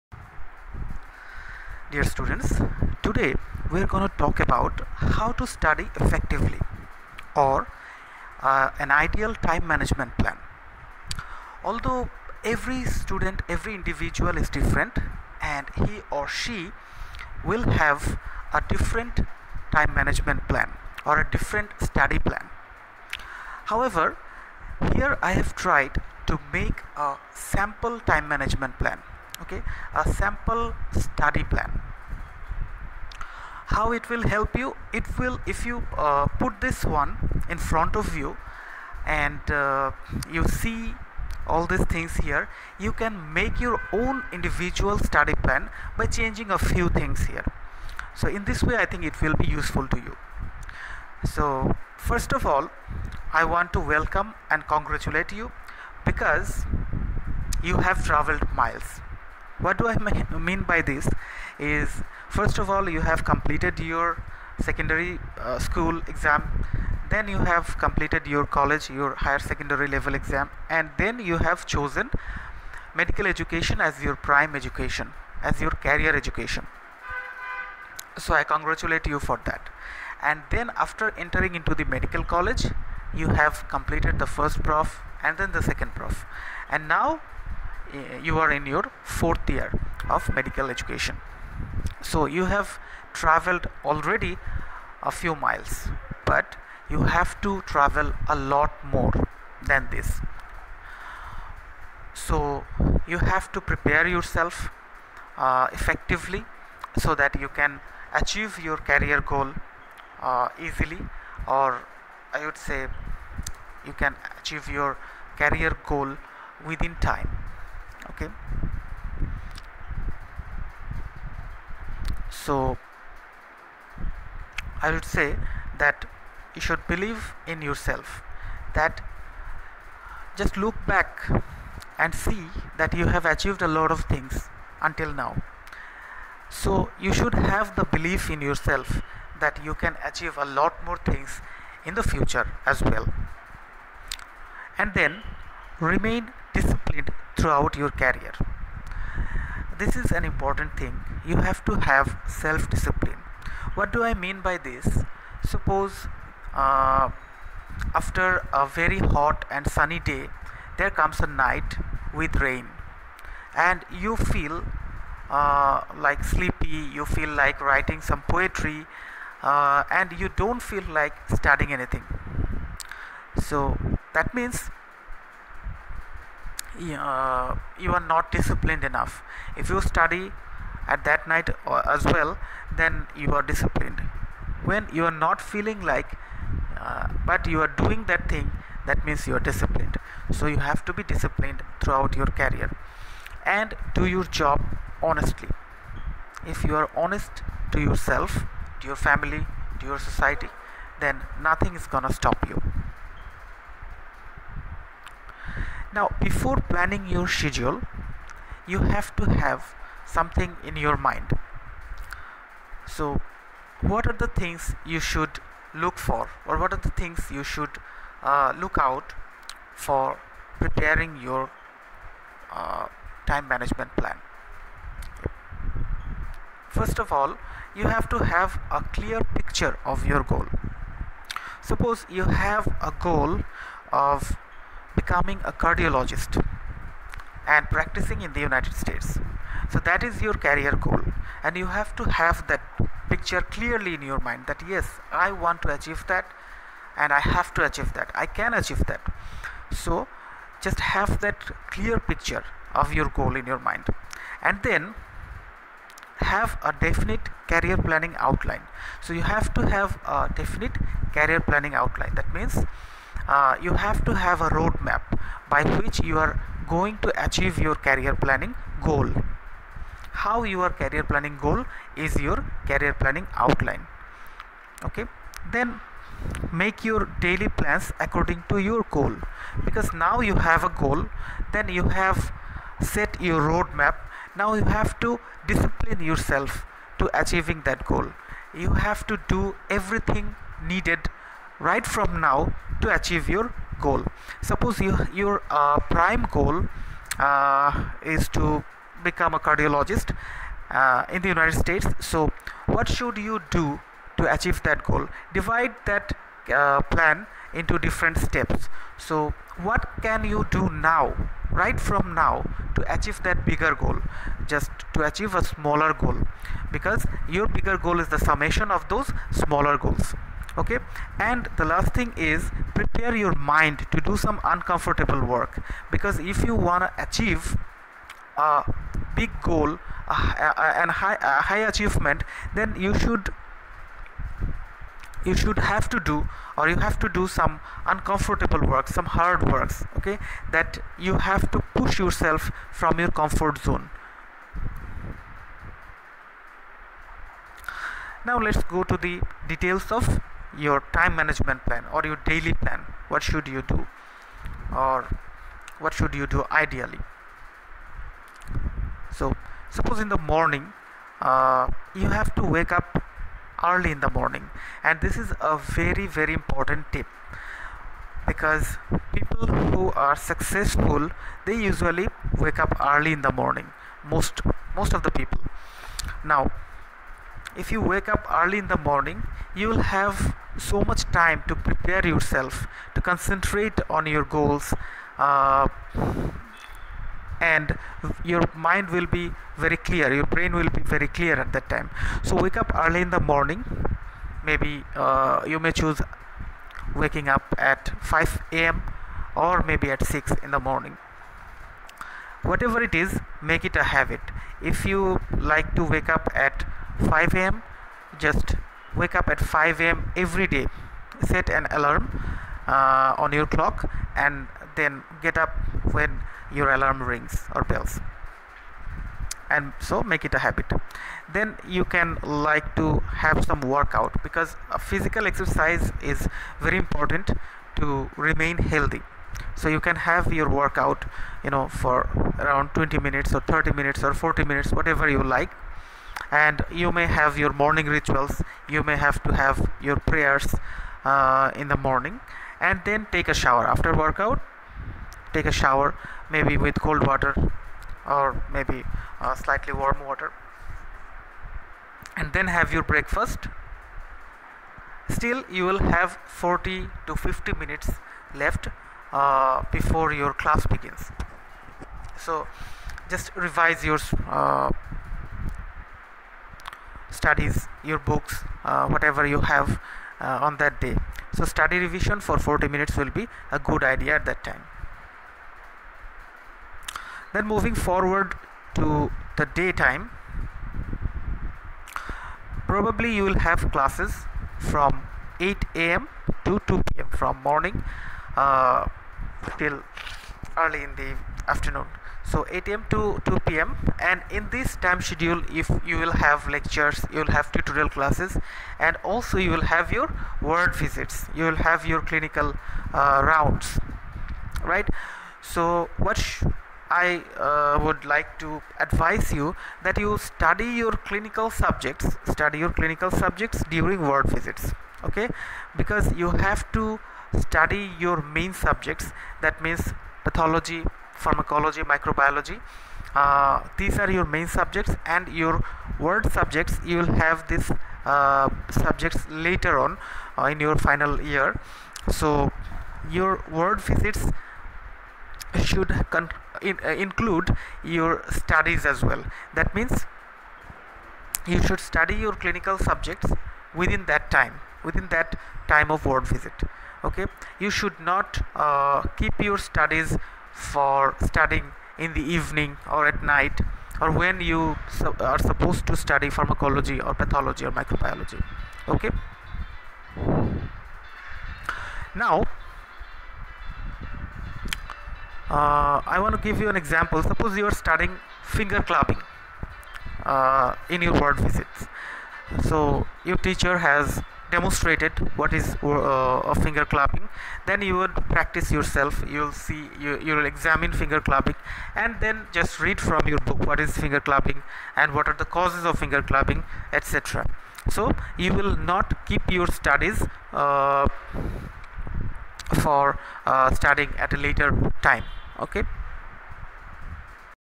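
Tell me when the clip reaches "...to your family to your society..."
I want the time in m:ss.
3:18.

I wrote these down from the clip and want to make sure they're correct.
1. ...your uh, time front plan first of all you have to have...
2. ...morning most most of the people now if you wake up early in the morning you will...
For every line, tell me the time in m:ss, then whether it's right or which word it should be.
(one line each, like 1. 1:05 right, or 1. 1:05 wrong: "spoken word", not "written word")
1. 3:41 wrong: "management", not "front"
2. 6:13 right.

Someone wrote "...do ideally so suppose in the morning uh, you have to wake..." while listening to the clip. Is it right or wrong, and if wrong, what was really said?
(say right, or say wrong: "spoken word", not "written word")
right.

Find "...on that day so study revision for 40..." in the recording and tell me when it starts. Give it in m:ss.
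7:50.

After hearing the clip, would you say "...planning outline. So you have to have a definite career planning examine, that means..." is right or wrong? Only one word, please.
wrong.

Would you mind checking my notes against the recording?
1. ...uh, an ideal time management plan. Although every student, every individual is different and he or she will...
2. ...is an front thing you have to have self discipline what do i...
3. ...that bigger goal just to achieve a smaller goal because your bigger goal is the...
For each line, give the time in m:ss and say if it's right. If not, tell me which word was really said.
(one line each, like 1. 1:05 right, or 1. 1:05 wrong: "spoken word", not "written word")
1. 0:08 right
2. 2:29 wrong: "important", not "front"
3. 5:13 right.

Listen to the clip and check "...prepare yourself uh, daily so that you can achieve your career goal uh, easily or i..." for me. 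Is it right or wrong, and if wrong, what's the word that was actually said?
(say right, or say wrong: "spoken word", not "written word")
wrong: "effectively", not "daily".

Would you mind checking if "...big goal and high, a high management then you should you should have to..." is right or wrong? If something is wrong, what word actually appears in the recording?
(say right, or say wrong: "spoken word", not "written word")
wrong: "achievement", not "management".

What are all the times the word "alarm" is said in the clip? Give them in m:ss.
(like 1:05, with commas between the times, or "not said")
6:51, 6:56.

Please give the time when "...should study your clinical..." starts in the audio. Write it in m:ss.
9:01.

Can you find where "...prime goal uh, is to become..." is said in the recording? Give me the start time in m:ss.
4:55.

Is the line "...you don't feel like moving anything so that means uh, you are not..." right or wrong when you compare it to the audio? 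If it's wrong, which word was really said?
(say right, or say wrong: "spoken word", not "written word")
wrong: "studying", not "moving".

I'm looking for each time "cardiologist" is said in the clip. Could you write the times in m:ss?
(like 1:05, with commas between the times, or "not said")
3:55, 4:59.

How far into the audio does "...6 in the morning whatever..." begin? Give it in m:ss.
6:40.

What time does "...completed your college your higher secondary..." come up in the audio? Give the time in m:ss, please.
1:07.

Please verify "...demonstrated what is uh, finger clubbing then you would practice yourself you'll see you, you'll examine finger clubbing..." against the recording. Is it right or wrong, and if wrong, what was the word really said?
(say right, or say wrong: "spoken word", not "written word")
right.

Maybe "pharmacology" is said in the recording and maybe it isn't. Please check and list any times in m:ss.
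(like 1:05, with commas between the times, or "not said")
8:41, 9:16.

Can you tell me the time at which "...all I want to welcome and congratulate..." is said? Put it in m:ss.
0:52.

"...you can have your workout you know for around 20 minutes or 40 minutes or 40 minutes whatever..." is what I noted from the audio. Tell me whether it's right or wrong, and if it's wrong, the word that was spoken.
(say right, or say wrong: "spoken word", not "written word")
wrong: "30", not "40".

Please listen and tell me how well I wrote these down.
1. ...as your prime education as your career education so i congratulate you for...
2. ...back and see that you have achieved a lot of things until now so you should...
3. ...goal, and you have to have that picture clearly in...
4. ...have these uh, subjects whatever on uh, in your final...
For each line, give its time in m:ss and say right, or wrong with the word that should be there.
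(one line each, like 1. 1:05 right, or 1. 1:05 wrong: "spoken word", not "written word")
1. 1:13 right
2. 2:10 right
3. 4:00 right
4. 8:47 wrong: "later", not "whatever".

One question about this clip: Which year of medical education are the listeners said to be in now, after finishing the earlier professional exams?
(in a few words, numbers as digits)
Fourth year.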